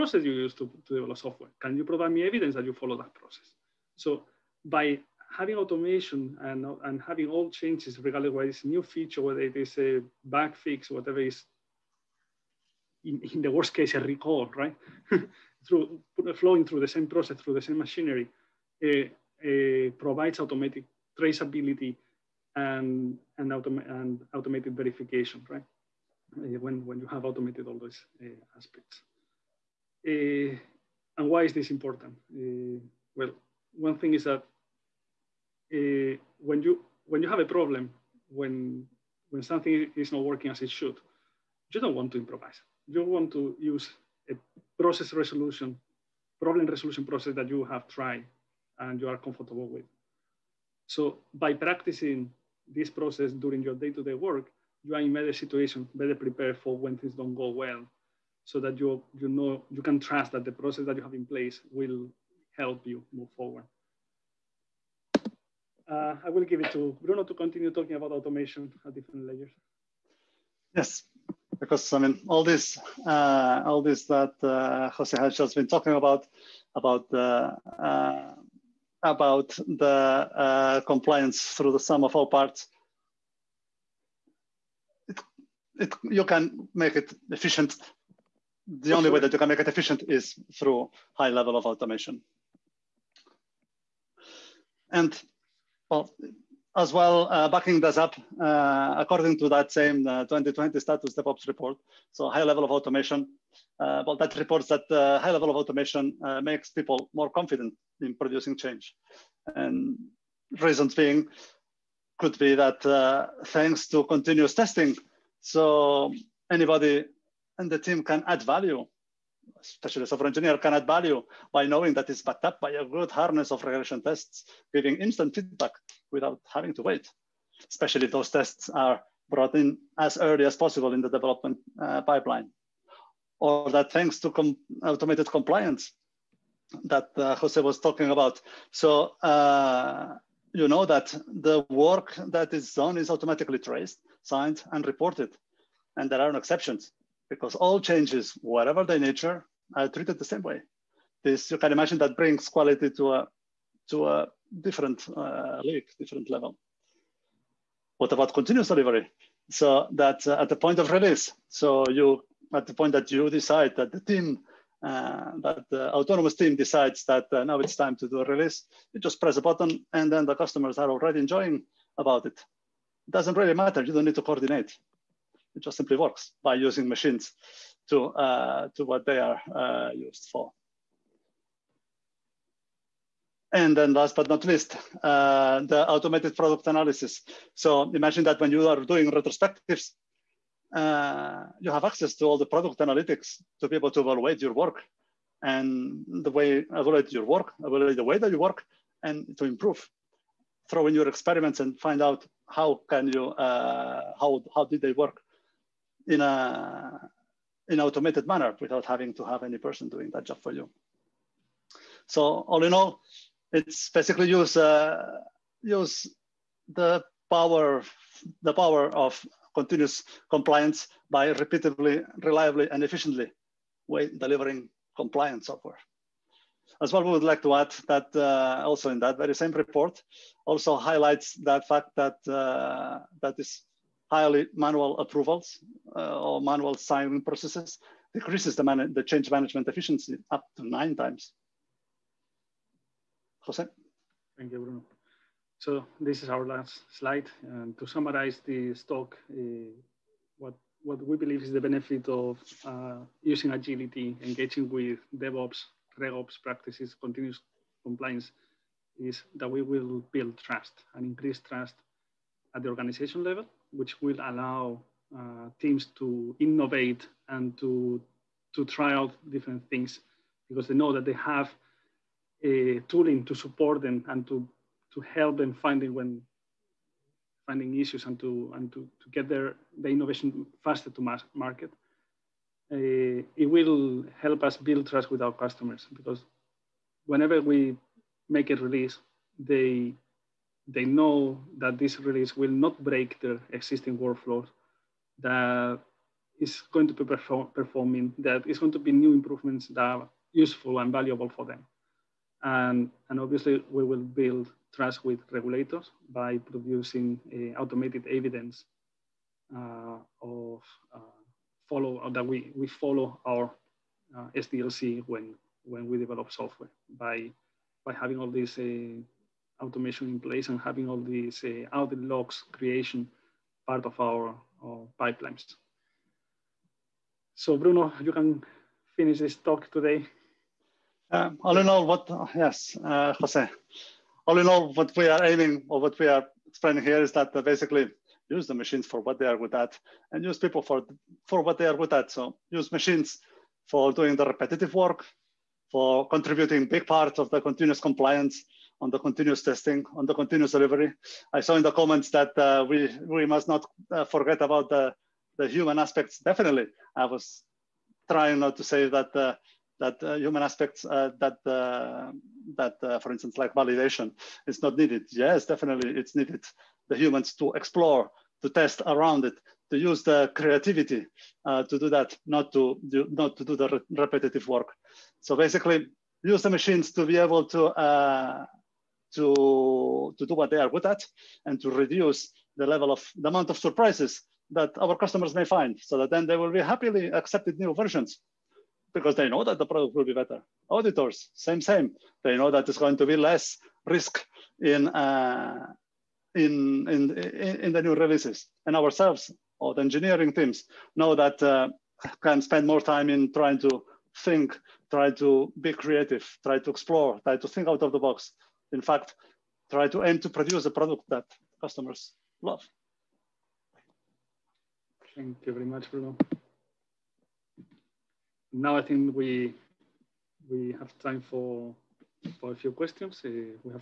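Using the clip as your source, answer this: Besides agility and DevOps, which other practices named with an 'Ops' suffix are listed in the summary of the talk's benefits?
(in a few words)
RegOps.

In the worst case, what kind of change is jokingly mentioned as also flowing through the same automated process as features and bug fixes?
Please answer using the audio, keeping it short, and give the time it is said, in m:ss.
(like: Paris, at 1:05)
A recall, at 0:13.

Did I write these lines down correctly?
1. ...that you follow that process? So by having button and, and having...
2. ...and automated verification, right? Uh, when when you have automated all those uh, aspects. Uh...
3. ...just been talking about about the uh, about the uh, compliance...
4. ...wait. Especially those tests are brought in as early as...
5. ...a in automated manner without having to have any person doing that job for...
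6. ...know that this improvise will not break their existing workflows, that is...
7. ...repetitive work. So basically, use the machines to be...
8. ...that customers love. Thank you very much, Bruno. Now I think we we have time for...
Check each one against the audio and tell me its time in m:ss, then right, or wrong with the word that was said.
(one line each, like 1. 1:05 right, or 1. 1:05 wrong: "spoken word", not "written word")
1. 0:02 wrong: "automation", not "button"
2. 0:23 right
3. 1:15 right
4. 2:06 right
5. 3:26 right
6. 4:50 wrong: "release", not "improvise"
7. 6:13 right
8. 6:51 right.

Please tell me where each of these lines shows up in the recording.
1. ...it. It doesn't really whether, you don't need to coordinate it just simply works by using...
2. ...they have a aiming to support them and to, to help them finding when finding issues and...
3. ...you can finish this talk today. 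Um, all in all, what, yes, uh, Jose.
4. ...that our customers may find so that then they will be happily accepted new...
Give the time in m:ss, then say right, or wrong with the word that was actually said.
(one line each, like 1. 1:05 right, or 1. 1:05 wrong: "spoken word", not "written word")
1. 2:52 wrong: "matter", not "whether"
2. 4:31 wrong: "tooling", not "aiming"
3. 5:28 right
4. 6:24 right.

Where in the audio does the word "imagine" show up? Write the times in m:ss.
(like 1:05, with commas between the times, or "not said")
2:31, 3:07.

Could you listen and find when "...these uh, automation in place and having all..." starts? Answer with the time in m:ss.
5:18.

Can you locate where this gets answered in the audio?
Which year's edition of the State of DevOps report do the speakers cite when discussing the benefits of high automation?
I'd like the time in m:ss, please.
1:40.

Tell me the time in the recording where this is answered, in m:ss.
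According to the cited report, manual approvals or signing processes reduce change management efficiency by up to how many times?
4:00.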